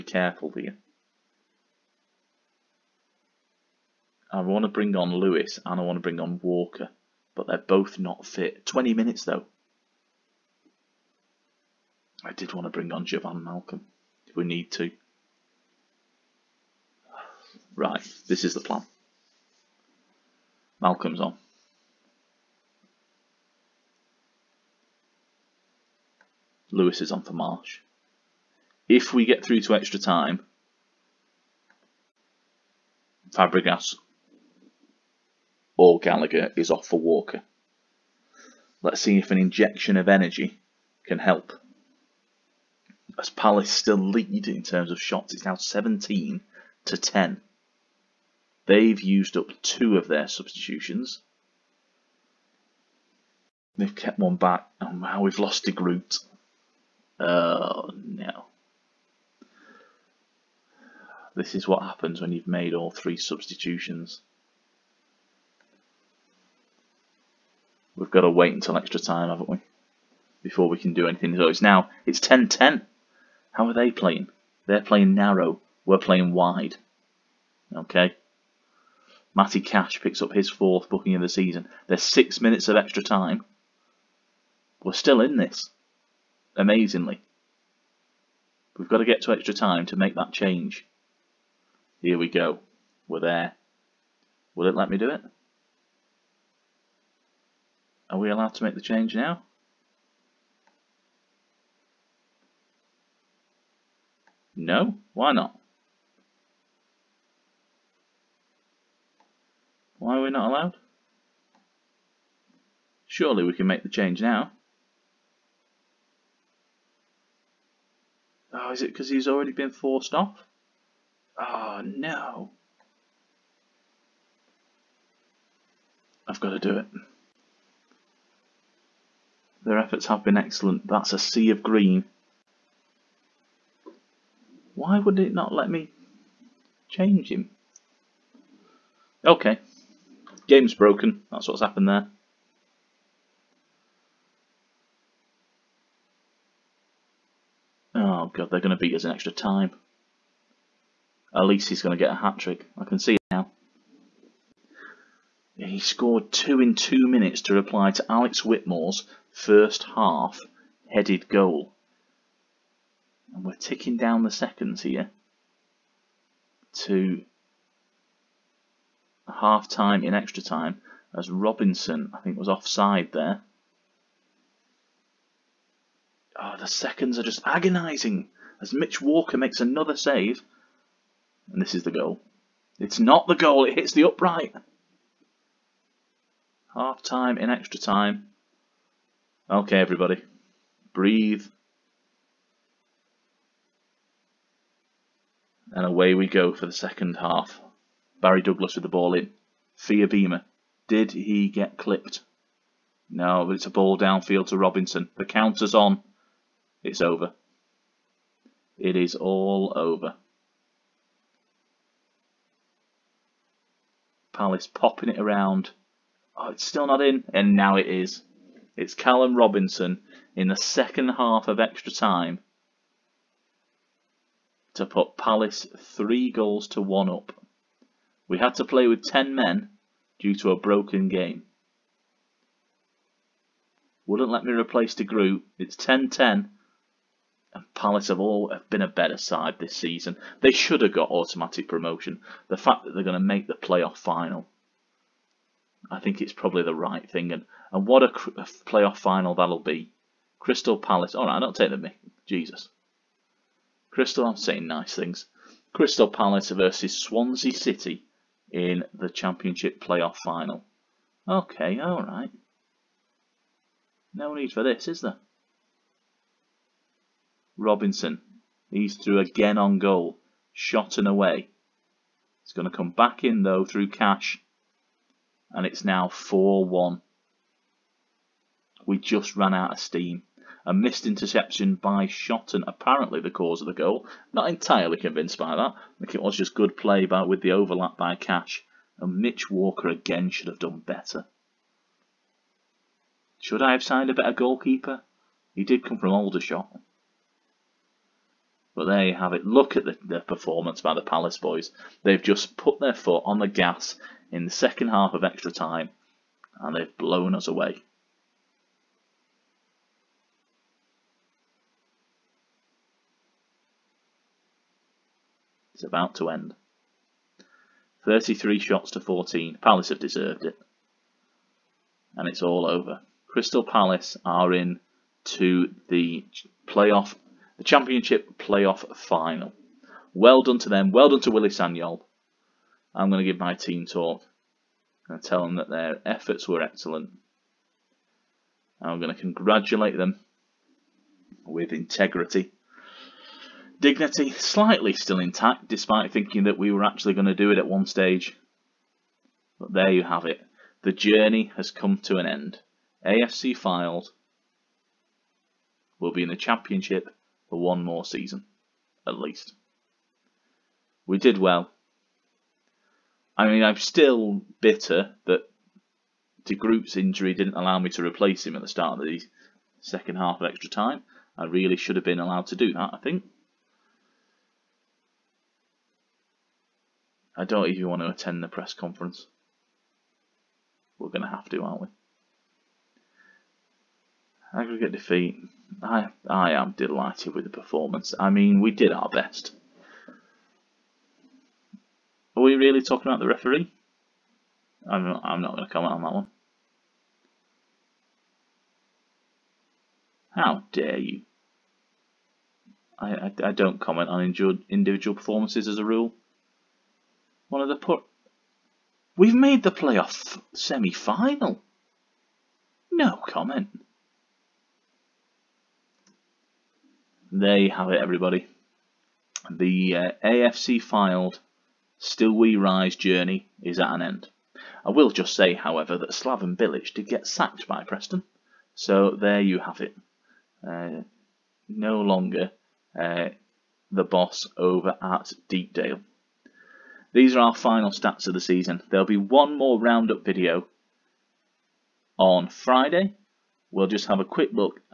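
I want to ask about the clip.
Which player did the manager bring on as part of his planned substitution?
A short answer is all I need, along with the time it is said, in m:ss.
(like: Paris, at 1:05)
Jovan Malcolm, at 0:13.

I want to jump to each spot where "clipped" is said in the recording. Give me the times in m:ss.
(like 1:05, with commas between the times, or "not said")
3:21.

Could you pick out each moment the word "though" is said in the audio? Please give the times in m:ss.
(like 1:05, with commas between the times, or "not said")
0:09, 4:33.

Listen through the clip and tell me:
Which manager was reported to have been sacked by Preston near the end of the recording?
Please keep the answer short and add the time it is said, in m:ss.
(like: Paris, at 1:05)
Slaven Bilic, at 7:06.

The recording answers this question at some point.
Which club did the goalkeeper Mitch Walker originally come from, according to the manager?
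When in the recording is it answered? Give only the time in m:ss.
4:56.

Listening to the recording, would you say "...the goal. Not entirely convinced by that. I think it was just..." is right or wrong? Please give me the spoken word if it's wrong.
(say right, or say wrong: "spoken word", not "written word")
right.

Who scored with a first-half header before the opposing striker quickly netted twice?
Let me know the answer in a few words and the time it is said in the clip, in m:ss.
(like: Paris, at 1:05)
Alex Whitmore, at 2:38.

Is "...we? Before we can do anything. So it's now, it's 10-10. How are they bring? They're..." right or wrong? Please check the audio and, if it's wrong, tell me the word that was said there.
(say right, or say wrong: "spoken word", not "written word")
wrong: "playing", not "bring".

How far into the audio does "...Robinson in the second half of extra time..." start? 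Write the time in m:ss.
3:39.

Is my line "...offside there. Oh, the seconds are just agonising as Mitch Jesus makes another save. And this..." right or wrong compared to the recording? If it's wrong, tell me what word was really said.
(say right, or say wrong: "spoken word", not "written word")
wrong: "Walker", not "Jesus".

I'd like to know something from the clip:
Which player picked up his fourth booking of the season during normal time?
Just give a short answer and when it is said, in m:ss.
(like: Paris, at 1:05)
Matty Cash, at 1:19.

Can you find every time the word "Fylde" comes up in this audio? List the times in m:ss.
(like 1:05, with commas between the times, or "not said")
5:53, 7:00.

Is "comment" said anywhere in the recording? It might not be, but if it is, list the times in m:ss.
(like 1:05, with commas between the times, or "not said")
6:35, 6:43, 6:53.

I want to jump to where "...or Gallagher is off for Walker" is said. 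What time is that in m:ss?
0:35.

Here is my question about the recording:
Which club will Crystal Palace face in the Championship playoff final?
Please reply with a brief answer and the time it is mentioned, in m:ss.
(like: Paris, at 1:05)
Swansea City, at 4:16.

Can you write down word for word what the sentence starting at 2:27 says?
Oh god, they're going to beat us in extra time.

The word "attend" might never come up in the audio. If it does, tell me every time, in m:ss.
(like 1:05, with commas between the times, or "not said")
6:18.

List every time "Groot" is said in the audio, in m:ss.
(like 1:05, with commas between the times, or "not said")
0:55, 3:55, 6:06.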